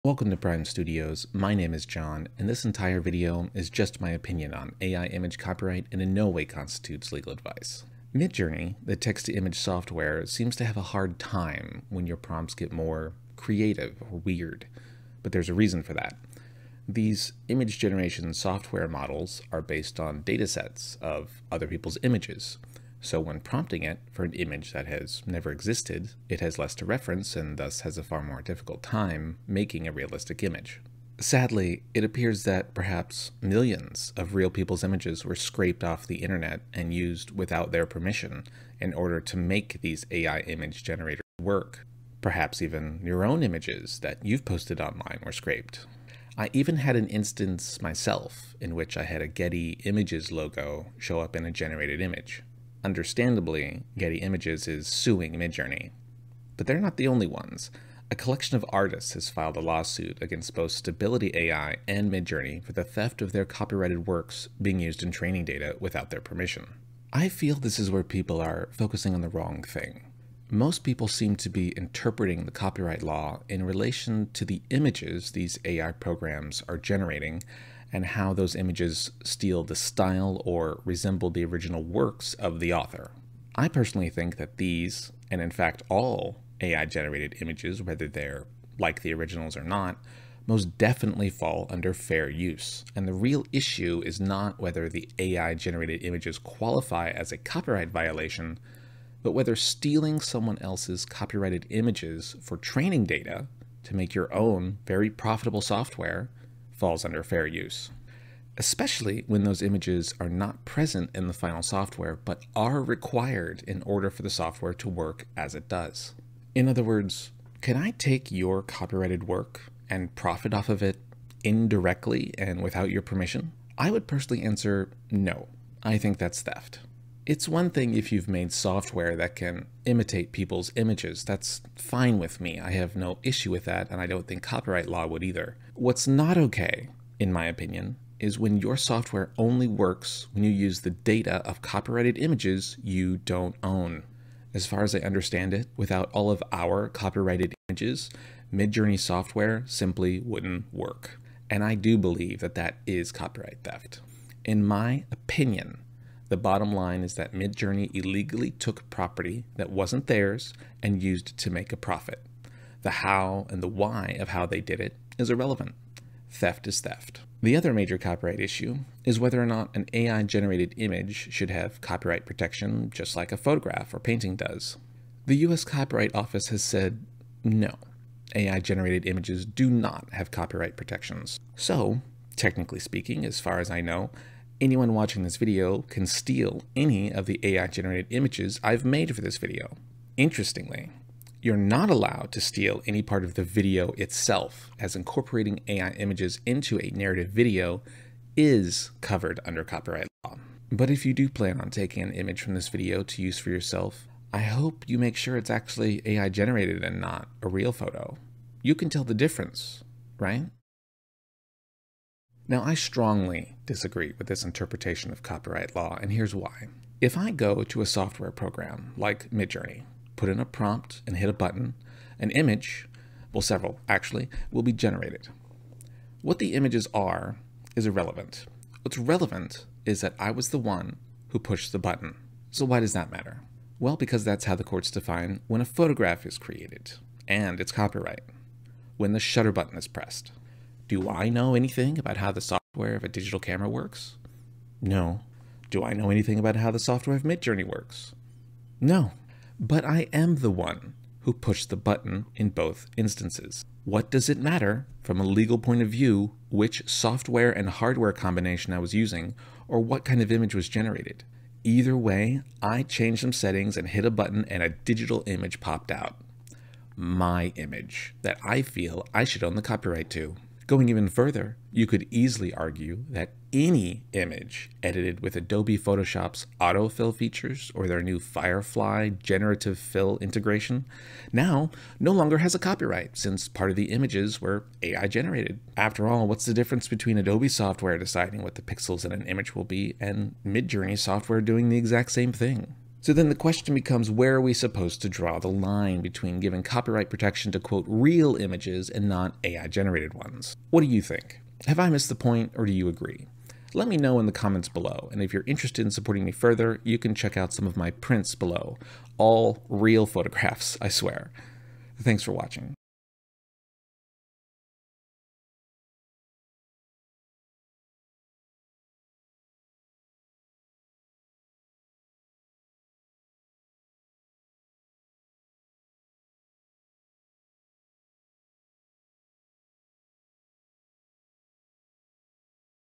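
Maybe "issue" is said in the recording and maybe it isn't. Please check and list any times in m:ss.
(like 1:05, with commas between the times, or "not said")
1:33, 2:13, 2:48.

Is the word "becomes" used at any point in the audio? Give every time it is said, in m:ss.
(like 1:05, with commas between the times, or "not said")
4:53.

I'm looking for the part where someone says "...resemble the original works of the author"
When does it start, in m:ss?
1:20.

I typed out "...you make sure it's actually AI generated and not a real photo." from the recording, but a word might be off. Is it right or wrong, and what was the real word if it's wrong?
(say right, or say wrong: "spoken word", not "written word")
right.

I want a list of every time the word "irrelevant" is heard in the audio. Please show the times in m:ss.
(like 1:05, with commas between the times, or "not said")
2:45, 3:47.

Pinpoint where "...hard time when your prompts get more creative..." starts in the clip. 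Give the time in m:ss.
0:10.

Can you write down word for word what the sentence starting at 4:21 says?
Either way, I changed some settings and hit a button and a digital image popped out.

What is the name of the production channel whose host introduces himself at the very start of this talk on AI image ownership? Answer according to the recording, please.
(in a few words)
Prime Studios.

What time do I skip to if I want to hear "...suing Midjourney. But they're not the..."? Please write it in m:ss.
0:54.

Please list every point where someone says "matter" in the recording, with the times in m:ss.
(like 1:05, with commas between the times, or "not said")
3:53, 4:14.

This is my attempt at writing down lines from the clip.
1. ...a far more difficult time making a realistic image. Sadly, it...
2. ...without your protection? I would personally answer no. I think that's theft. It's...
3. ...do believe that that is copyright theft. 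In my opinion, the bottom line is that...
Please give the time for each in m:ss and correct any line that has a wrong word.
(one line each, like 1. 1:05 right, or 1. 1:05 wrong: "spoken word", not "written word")
1. 0:27 right
2. 2:02 wrong: "permission", not "protection"
3. 2:31 right.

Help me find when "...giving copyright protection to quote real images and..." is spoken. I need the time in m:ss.
4:56.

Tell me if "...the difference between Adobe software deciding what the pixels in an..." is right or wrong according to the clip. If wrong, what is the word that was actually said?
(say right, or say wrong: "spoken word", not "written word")
right.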